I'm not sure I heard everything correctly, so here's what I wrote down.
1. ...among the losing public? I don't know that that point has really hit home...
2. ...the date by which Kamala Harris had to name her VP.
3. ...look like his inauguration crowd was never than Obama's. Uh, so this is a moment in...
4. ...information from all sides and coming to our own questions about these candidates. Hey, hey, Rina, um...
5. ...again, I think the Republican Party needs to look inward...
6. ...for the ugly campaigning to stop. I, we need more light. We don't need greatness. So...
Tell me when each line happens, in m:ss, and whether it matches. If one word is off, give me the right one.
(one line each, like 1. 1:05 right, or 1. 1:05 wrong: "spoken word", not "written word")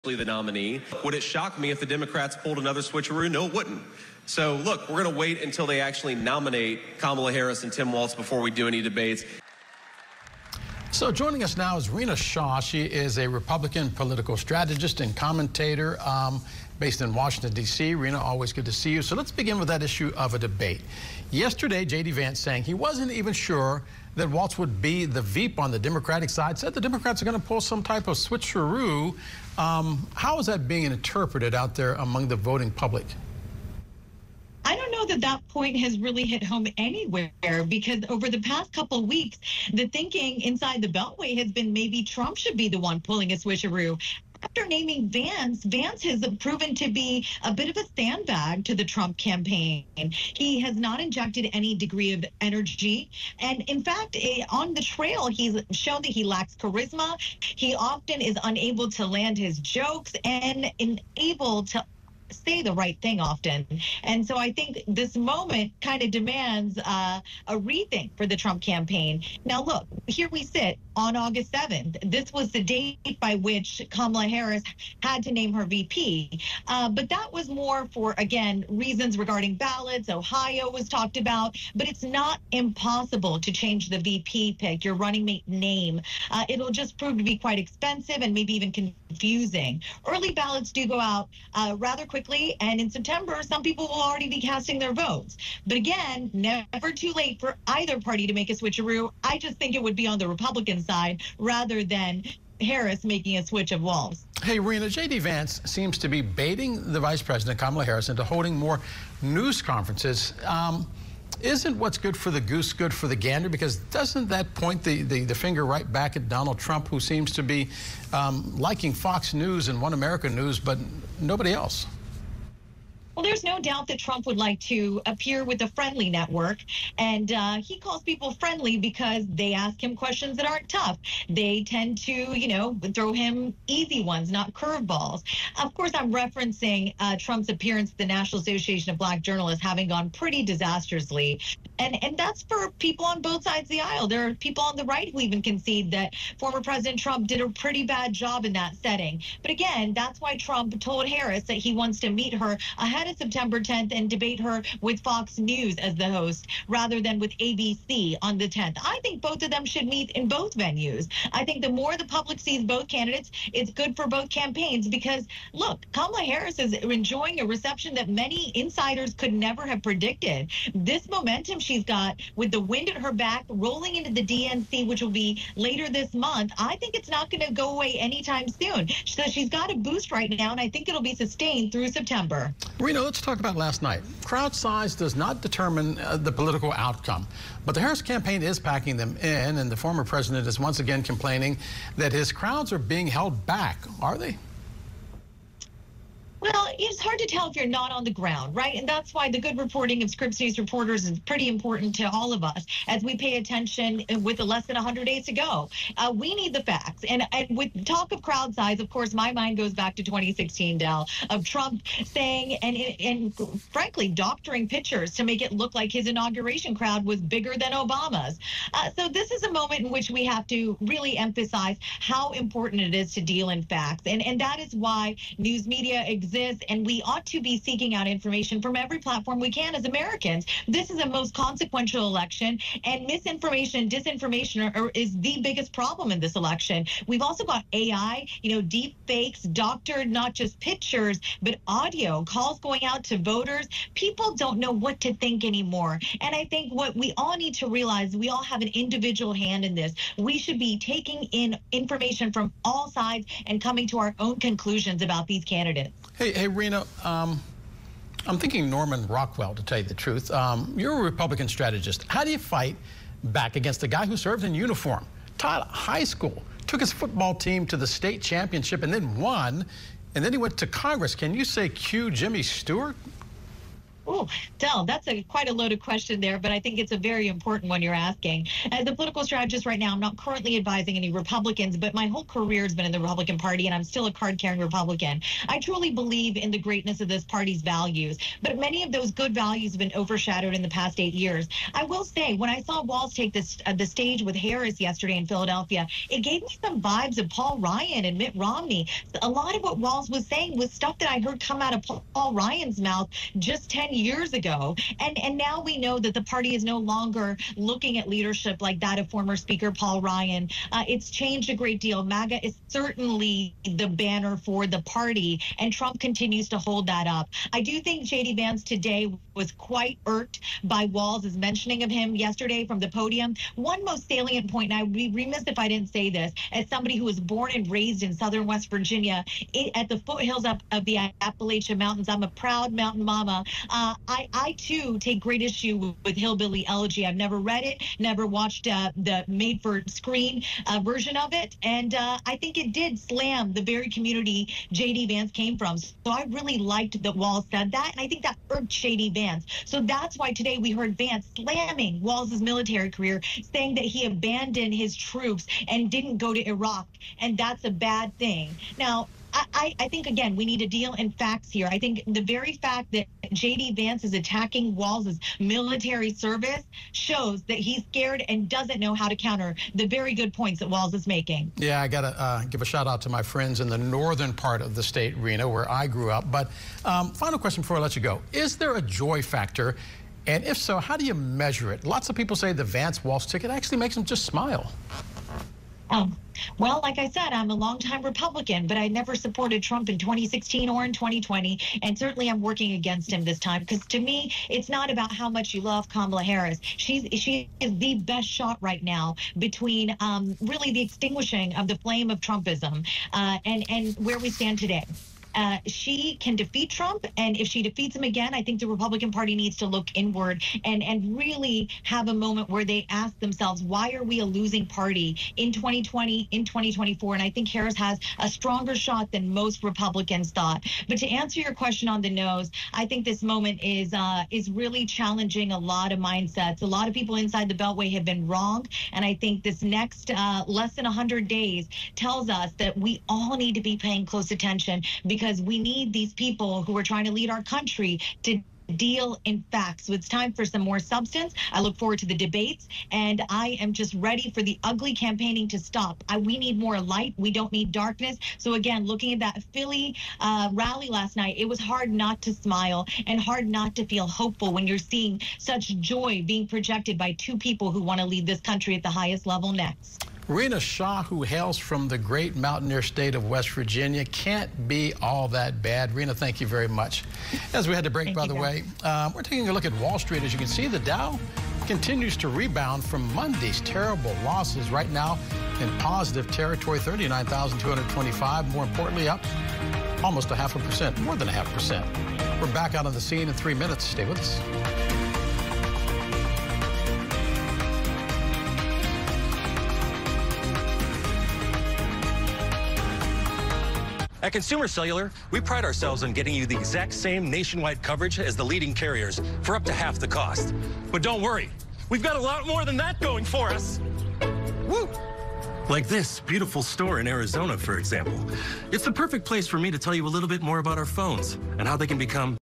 1. 0:31 wrong: "voting", not "losing"
2. 1:12 right
3. 3:35 wrong: "bigger", not "never"
4. 4:11 wrong: "conclusions", not "questions"
5. 6:48 right
6. 7:24 wrong: "darkness", not "greatness".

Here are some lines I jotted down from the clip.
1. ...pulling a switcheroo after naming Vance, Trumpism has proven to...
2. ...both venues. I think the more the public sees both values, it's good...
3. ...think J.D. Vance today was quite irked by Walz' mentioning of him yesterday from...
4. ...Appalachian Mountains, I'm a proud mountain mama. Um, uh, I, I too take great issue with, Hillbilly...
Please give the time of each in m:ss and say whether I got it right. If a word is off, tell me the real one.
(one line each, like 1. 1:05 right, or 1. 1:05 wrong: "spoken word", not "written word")
1. 0:43 wrong: "Vance", not "Trumpism"
2. 2:40 wrong: "candidates", not "values"
3. 5:17 right
4. 5:31 right.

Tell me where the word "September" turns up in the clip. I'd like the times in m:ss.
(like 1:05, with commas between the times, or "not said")
1:32, 2:33, 3:01.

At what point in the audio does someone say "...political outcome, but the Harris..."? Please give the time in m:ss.
3:06.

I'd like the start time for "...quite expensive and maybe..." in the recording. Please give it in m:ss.
1:27.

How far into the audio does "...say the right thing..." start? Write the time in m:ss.
1:02.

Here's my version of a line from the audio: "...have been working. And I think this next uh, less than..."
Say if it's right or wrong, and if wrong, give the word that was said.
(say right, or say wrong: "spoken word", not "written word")
wrong: "wrong", not "working".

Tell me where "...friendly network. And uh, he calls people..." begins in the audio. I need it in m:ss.
2:05.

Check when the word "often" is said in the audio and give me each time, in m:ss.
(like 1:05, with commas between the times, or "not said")
0:57, 1:03.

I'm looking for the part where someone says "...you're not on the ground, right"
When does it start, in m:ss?
3:17.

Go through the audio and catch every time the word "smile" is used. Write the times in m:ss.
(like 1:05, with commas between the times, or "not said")
6:24, 7:32.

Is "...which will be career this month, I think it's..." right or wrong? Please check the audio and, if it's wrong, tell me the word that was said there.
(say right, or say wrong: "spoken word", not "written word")
wrong: "later", not "career".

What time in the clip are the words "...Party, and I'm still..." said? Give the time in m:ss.
4:43.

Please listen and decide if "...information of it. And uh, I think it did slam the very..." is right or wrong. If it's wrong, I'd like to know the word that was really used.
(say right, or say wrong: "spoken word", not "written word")
wrong: "version", not "information".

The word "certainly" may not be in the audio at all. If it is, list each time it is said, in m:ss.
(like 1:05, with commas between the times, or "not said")
5:12, 6:31.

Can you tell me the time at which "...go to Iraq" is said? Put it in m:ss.
5:56.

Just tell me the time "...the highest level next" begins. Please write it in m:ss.
7:38.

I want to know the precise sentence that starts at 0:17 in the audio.
Rina, always good to see you.